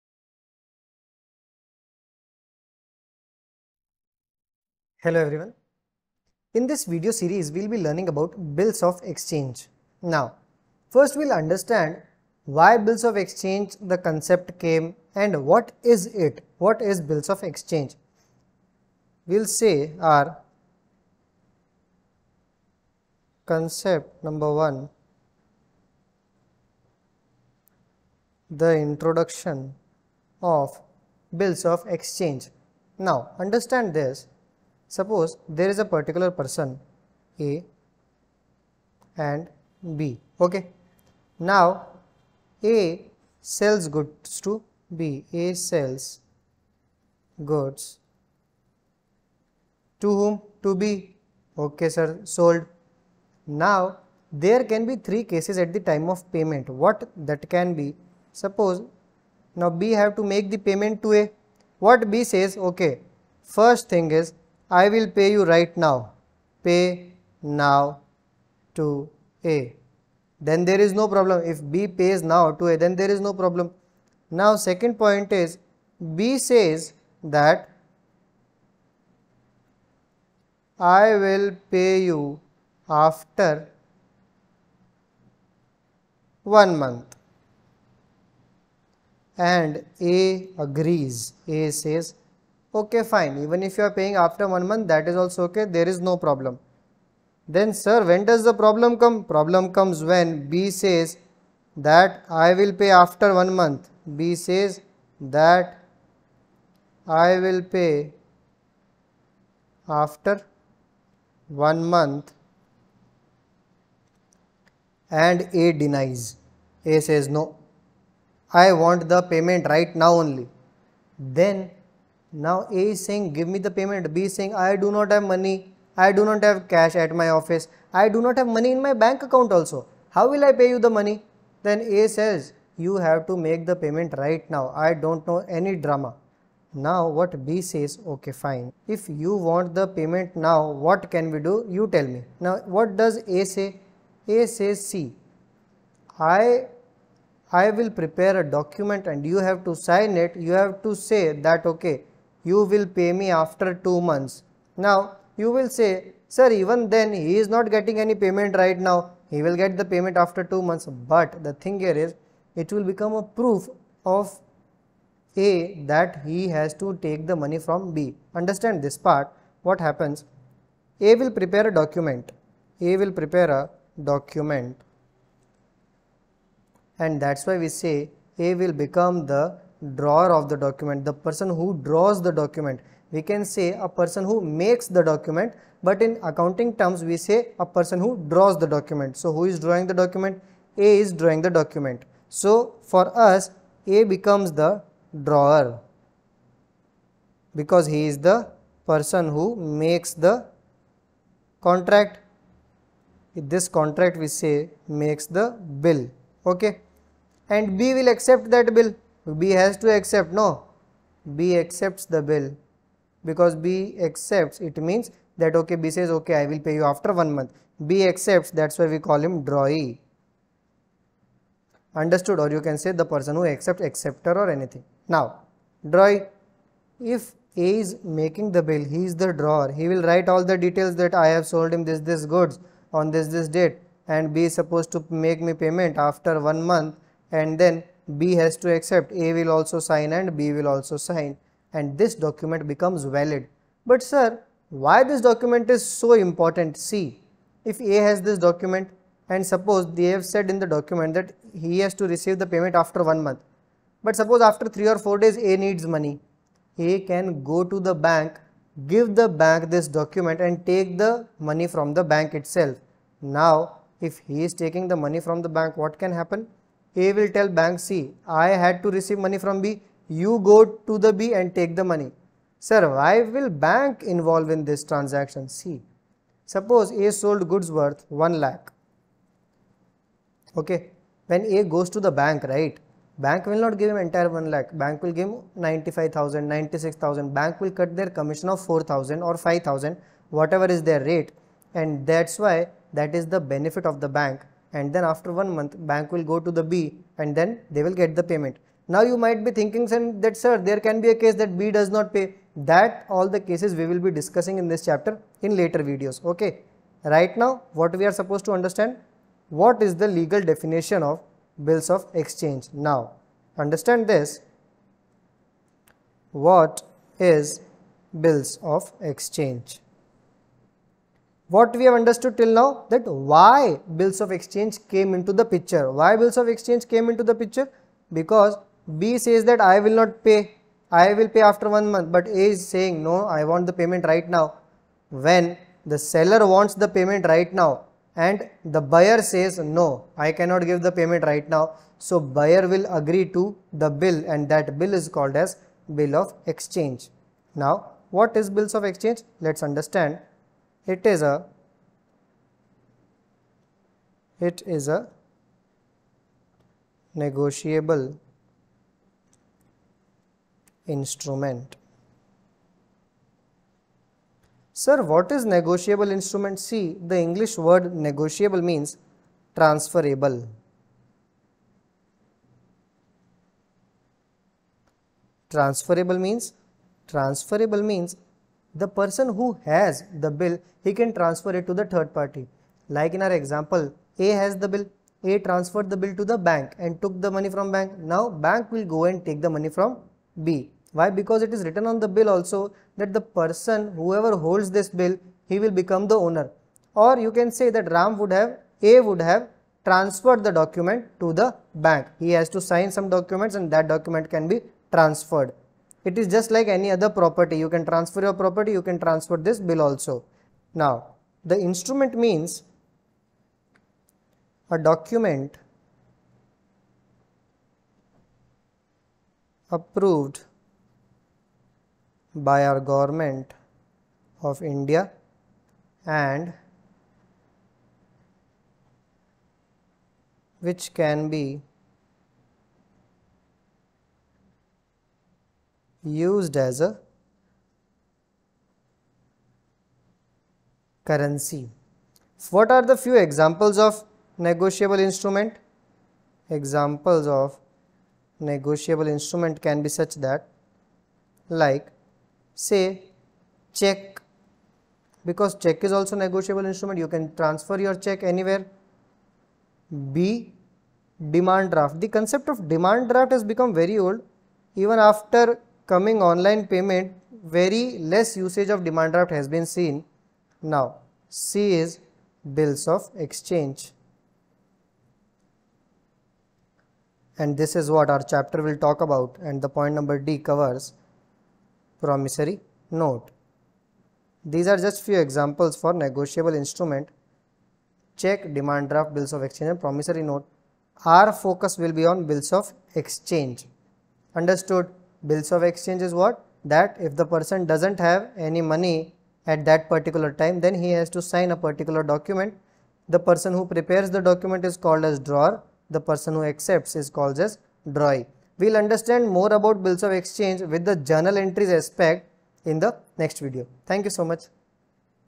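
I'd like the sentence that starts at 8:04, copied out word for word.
These are just few examples for negotiable instrument.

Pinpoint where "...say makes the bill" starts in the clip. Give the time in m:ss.
3:24.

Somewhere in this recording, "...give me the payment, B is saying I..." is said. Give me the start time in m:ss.
2:03.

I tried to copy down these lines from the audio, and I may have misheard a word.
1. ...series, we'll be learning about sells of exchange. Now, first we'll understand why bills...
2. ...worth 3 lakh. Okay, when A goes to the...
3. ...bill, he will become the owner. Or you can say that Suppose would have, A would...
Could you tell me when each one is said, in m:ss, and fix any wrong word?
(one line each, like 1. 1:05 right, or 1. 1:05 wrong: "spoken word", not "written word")
1. 0:07 wrong: "bills", not "sells"
2. 4:37 wrong: "1", not "3"
3. 6:34 wrong: "Ram", not "Suppose".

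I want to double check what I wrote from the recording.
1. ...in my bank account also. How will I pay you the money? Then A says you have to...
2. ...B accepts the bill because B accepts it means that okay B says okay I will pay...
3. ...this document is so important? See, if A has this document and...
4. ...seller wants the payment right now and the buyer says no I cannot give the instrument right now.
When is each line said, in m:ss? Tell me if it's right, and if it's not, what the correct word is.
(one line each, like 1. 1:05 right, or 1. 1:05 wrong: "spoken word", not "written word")
1. 2:08 right
2. 3:31 right
3. 4:05 right
4. 5:35 wrong: "payment", not "instrument".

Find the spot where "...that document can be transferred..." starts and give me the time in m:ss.
6:43.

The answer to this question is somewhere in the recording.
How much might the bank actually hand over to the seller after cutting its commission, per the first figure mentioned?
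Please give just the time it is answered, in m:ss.
4:45.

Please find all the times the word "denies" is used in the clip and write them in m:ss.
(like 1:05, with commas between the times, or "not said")
1:55.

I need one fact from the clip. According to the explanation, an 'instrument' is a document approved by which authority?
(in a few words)
government of India.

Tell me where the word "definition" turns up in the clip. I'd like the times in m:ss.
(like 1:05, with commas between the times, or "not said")
5:10.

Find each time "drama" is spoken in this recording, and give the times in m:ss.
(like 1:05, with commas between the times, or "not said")
2:15.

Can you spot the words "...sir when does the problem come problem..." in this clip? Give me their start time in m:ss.
1:37.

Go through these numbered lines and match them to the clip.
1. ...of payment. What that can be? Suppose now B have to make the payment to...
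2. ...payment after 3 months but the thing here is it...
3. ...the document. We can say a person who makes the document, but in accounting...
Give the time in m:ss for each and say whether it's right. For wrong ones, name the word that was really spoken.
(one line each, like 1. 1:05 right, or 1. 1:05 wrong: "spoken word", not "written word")
1. 0:56 right
2. 2:39 wrong: "2", not "3"
3. 3:02 right.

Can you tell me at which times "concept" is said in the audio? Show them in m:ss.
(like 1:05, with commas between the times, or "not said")
0:13, 0:23, 7:42.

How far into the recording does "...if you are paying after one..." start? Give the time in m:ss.
1:33.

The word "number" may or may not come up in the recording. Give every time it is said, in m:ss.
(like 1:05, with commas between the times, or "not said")
0:24, 7:59.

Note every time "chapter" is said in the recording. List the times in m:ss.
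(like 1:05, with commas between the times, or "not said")
5:04, 7:58.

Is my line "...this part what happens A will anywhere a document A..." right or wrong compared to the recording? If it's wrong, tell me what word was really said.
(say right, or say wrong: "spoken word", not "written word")
wrong: "prepare", not "anywhere".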